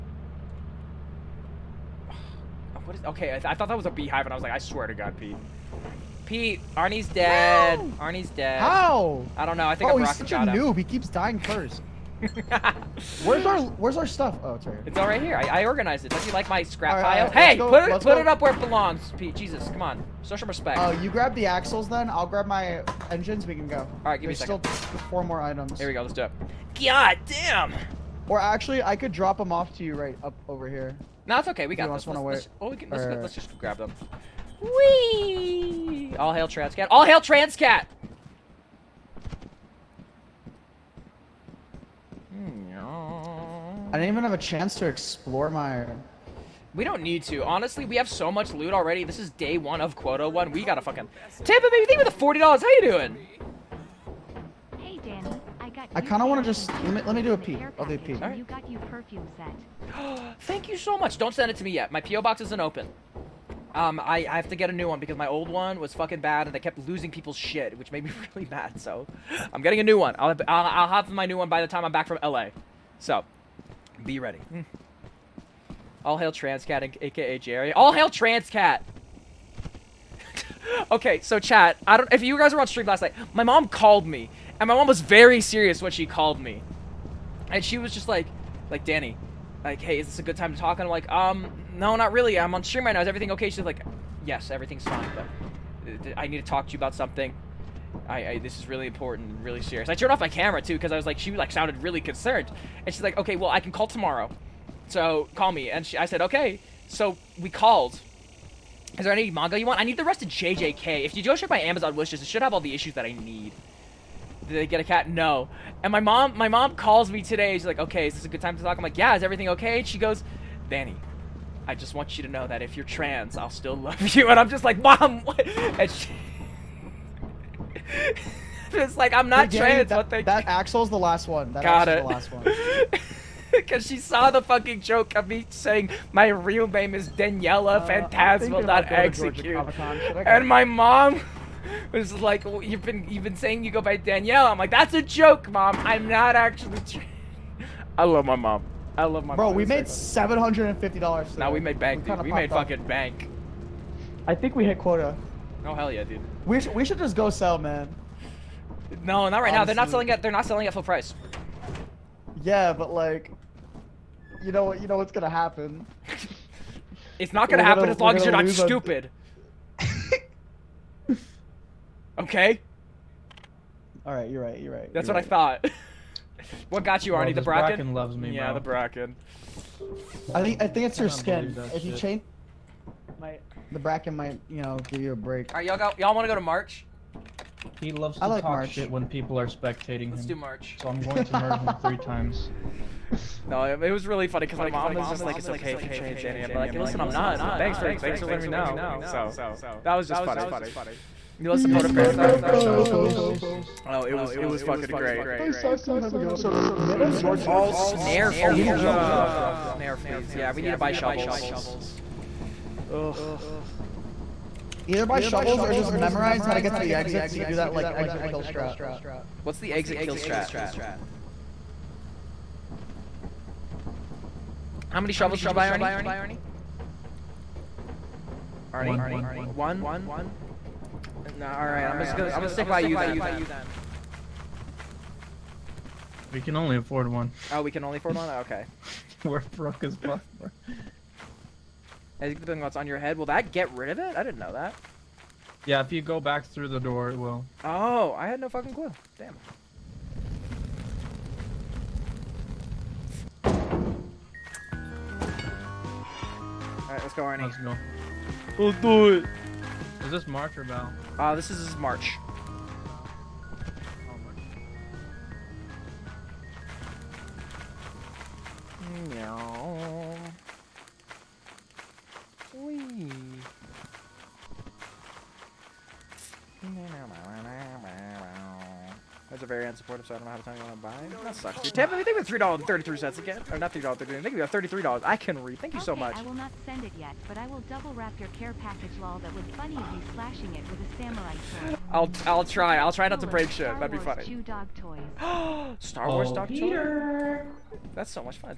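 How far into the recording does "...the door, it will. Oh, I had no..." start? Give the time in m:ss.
4:06.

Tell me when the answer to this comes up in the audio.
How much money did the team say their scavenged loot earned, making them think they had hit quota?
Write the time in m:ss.
2:29.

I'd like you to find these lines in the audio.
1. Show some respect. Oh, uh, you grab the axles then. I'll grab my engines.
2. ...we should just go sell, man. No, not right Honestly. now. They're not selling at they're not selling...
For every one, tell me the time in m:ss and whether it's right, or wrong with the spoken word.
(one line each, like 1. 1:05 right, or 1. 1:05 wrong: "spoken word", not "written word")
1. 0:20 right
2. 2:36 right.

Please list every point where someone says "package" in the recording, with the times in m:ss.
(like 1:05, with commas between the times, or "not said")
4:48.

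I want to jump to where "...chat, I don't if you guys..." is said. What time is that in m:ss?
1:21.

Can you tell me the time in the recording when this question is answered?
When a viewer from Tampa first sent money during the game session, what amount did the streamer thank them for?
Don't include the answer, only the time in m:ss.
0:52.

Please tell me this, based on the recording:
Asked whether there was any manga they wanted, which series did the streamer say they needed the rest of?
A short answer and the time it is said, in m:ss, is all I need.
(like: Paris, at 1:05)
JJK, at 1:50.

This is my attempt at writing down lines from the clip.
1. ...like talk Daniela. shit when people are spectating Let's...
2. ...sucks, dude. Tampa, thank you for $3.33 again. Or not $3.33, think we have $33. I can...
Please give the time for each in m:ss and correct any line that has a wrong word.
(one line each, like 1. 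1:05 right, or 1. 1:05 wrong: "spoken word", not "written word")
1. 3:08 wrong: "March", not "Daniela"
2. 4:41 right.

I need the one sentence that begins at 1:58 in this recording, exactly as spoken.
I'm like, yeah, is everything okay?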